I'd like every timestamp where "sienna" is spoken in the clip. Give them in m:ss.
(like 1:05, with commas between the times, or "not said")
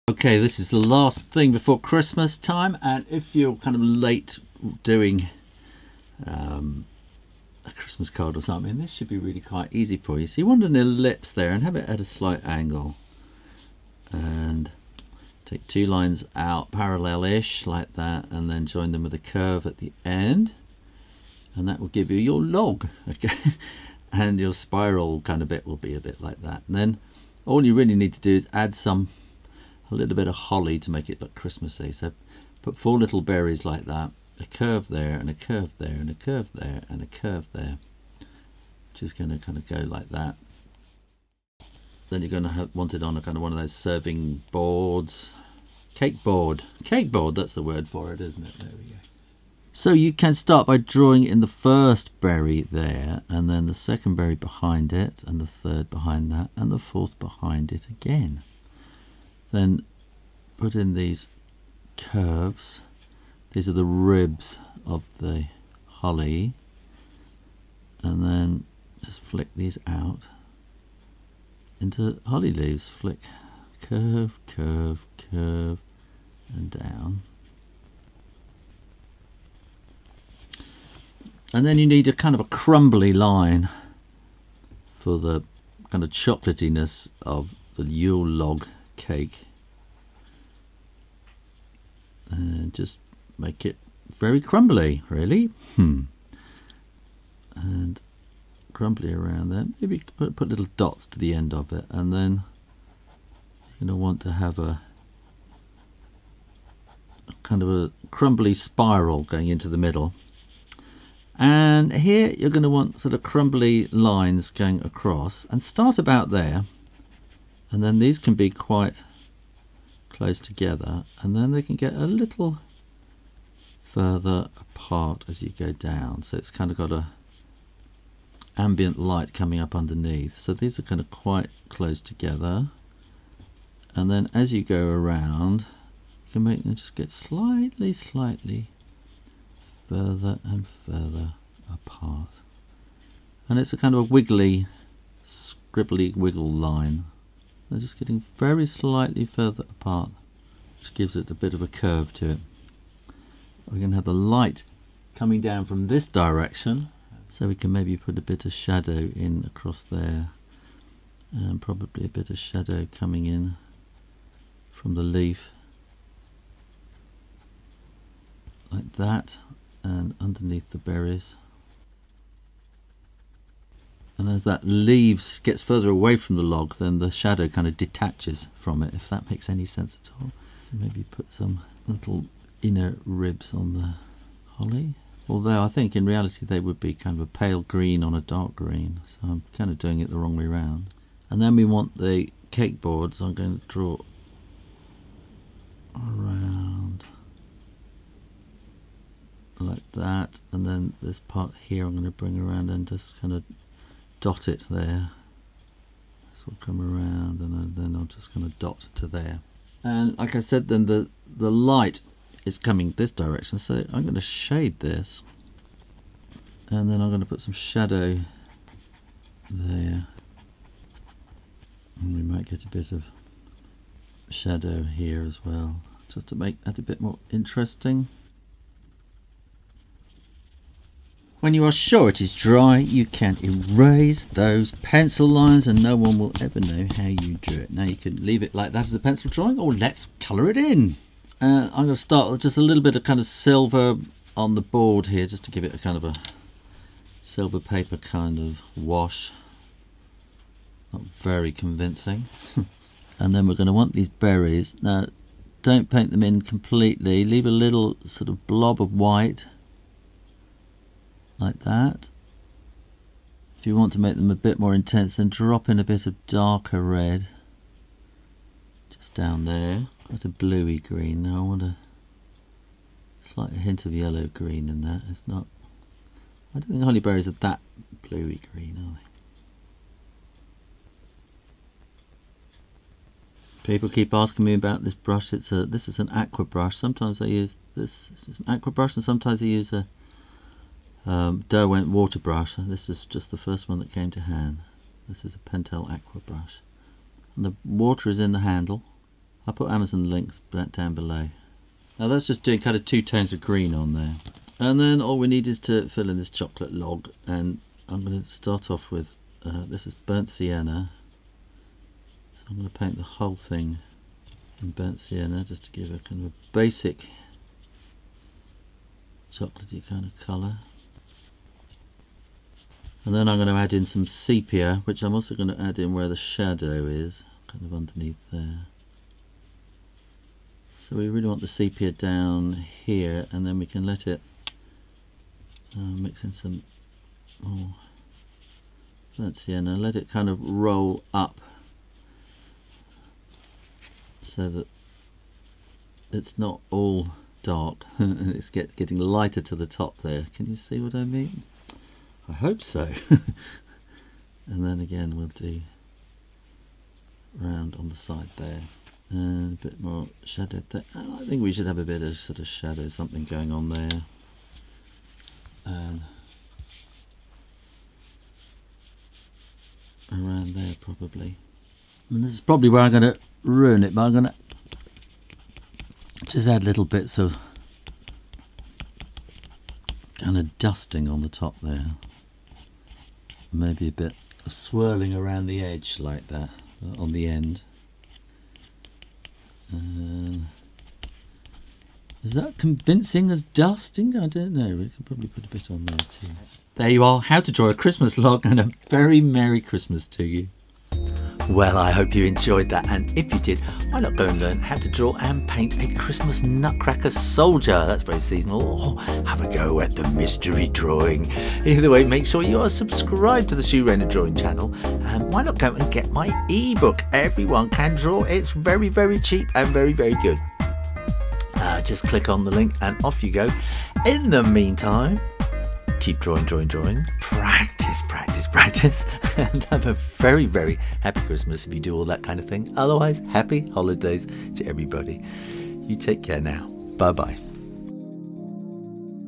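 5:10, 5:14.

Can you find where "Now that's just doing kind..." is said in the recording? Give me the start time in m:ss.
5:01.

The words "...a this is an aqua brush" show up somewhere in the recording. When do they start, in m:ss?
4:45.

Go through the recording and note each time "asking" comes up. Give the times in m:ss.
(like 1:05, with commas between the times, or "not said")
4:44.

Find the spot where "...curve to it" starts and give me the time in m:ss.
2:31.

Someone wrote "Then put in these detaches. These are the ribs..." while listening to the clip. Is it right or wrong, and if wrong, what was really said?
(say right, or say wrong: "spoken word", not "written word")
wrong: "curves", not "detaches".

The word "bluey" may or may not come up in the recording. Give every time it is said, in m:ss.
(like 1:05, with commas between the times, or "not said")
4:30, 4:38.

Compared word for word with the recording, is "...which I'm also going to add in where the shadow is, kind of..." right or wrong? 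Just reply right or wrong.
right.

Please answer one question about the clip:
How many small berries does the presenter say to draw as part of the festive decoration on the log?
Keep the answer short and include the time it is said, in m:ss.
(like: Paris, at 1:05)
4, at 0:32.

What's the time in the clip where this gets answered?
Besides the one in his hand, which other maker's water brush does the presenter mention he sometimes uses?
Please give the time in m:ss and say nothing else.
4:51.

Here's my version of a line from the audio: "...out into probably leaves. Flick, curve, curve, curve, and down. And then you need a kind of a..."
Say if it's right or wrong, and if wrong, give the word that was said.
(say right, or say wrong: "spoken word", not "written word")
wrong: "holly", not "probably".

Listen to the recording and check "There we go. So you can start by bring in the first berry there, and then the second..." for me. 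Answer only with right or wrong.
wrong.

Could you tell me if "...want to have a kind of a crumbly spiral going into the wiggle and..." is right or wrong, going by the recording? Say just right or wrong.
wrong.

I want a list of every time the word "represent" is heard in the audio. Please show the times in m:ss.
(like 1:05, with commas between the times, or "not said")
not said.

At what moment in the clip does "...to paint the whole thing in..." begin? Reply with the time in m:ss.
5:12.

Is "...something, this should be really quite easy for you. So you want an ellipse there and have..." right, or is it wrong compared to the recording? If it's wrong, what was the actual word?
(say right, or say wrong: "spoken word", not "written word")
right.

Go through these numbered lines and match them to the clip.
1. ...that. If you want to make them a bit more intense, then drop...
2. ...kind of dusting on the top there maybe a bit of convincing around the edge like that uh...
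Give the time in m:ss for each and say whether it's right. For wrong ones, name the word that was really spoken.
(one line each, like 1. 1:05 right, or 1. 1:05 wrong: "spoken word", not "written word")
1. 4:21 right
2. 6:20 wrong: "swirling", not "convincing".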